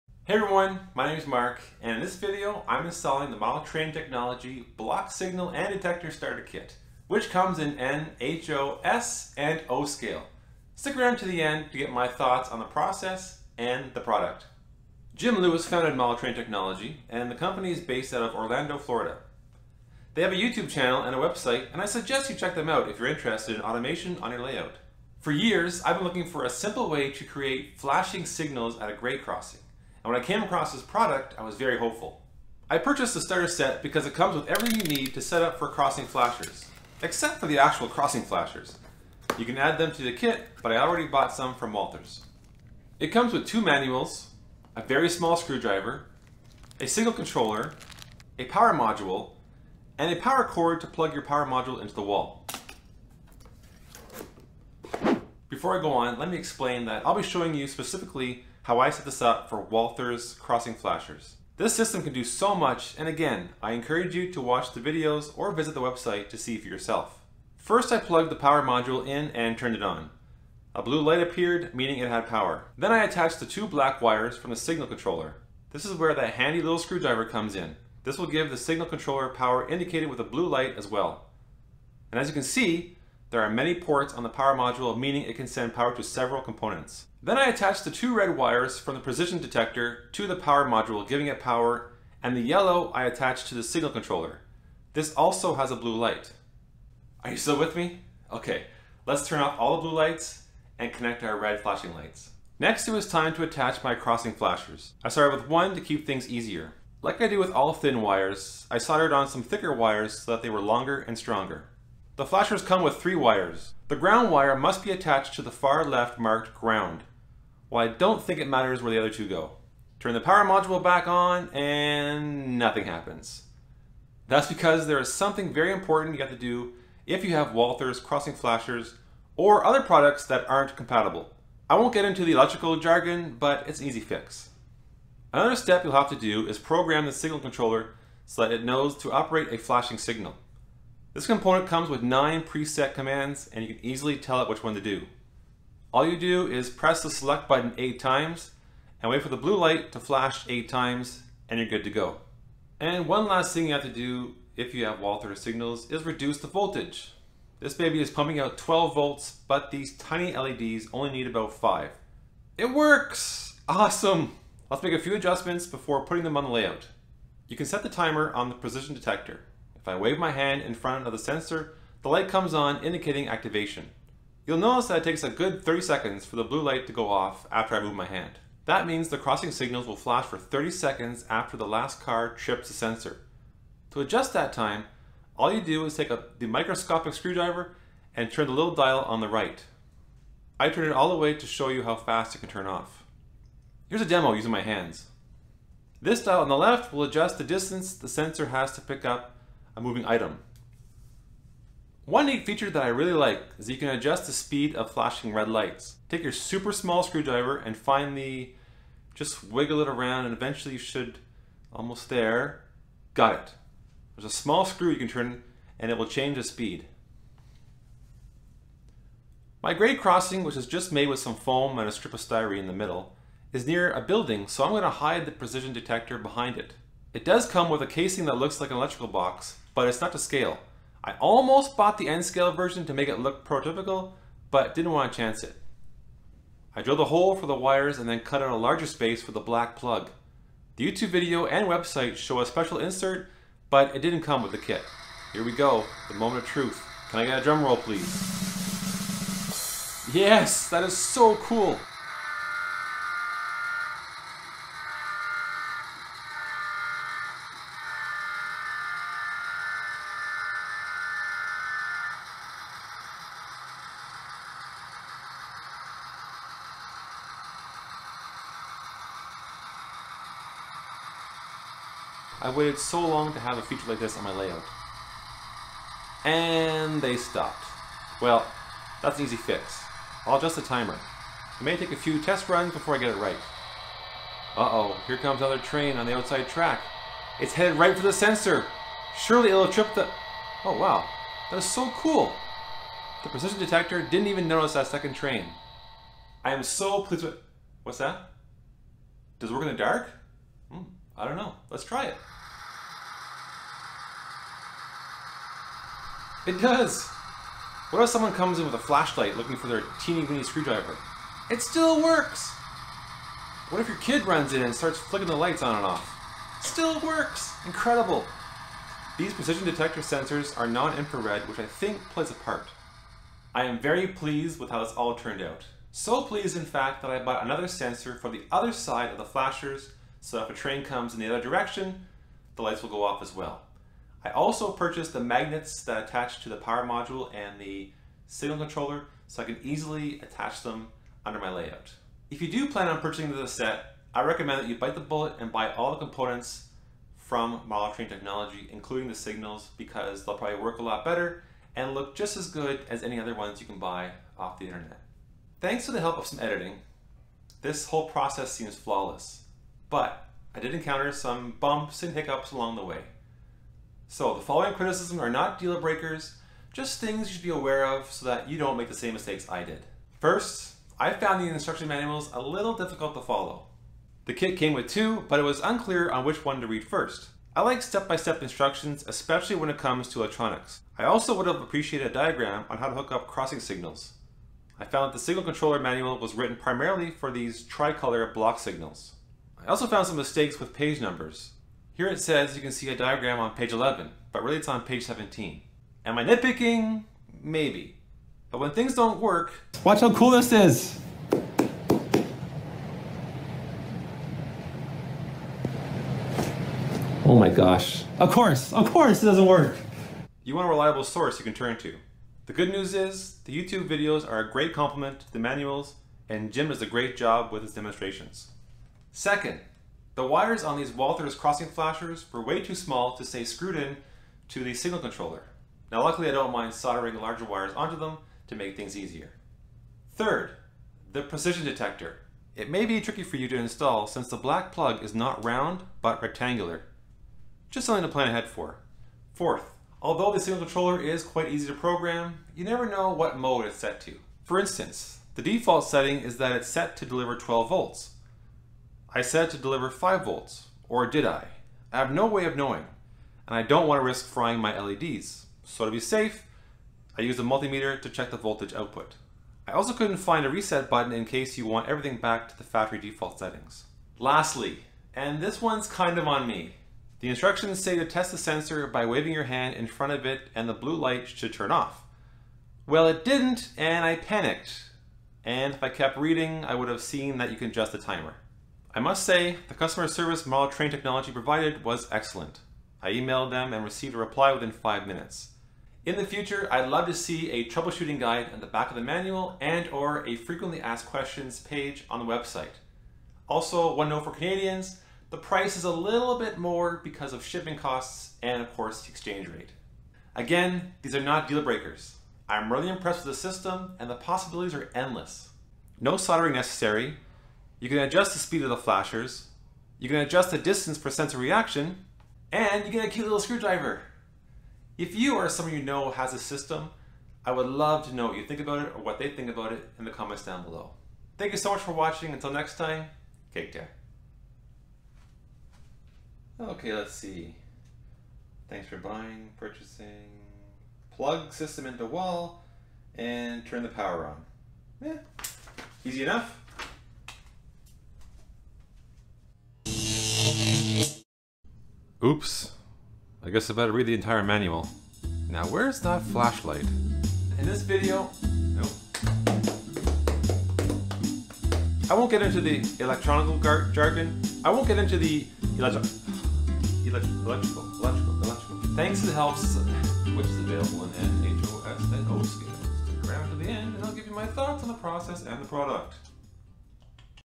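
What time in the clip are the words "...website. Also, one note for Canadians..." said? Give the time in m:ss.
8:12.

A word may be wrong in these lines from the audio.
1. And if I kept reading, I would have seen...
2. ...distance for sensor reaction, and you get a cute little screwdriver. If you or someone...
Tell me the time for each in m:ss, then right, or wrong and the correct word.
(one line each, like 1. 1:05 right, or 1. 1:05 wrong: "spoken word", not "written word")
1. 7:55 right
2. 8:30 right.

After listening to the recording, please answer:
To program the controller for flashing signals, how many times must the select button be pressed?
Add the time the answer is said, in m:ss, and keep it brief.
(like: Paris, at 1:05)
8, at 2:26.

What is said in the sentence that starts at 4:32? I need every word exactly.
I waited so long to have a feature like this on my layout.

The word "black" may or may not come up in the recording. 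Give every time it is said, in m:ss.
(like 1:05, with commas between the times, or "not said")
1:13, 3:59, 7:14.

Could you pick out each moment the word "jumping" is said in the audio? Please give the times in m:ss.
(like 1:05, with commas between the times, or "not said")
not said.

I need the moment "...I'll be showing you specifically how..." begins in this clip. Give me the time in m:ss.
0:57.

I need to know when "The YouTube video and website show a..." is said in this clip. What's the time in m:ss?
4:00.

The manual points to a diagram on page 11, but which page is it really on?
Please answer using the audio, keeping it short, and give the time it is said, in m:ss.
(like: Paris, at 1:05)
17, at 6:34.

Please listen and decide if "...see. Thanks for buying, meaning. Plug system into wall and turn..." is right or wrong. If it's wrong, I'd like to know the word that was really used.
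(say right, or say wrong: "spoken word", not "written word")
wrong: "purchasing", not "meaning".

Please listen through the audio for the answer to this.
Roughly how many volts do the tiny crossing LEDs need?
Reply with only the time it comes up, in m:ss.
2:40.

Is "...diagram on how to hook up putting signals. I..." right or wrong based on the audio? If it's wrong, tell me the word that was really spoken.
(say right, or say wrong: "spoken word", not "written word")
wrong: "crossing", not "putting".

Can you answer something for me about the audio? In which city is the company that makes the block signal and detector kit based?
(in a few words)
Orlando, Florida.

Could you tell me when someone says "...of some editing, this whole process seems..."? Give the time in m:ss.
5:56.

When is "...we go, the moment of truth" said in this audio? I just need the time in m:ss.
4:05.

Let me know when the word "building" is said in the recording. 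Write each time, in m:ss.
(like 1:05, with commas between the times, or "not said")
3:44.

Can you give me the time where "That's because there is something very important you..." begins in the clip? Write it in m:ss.
2:04.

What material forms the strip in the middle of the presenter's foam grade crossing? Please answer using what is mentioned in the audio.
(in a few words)
styrene.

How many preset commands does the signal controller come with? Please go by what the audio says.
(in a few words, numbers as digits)
9.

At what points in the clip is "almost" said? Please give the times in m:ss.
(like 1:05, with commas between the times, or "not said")
3:31, 3:51.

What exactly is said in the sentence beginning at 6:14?
The kit came with two, but it was unclear on which one to read first.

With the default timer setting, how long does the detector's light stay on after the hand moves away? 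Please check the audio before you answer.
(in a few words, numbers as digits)
30 seconds.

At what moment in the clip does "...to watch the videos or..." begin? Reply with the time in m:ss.
1:04.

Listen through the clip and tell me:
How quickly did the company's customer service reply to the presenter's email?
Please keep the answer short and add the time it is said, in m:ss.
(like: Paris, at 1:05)
within five minutes, at 8:04.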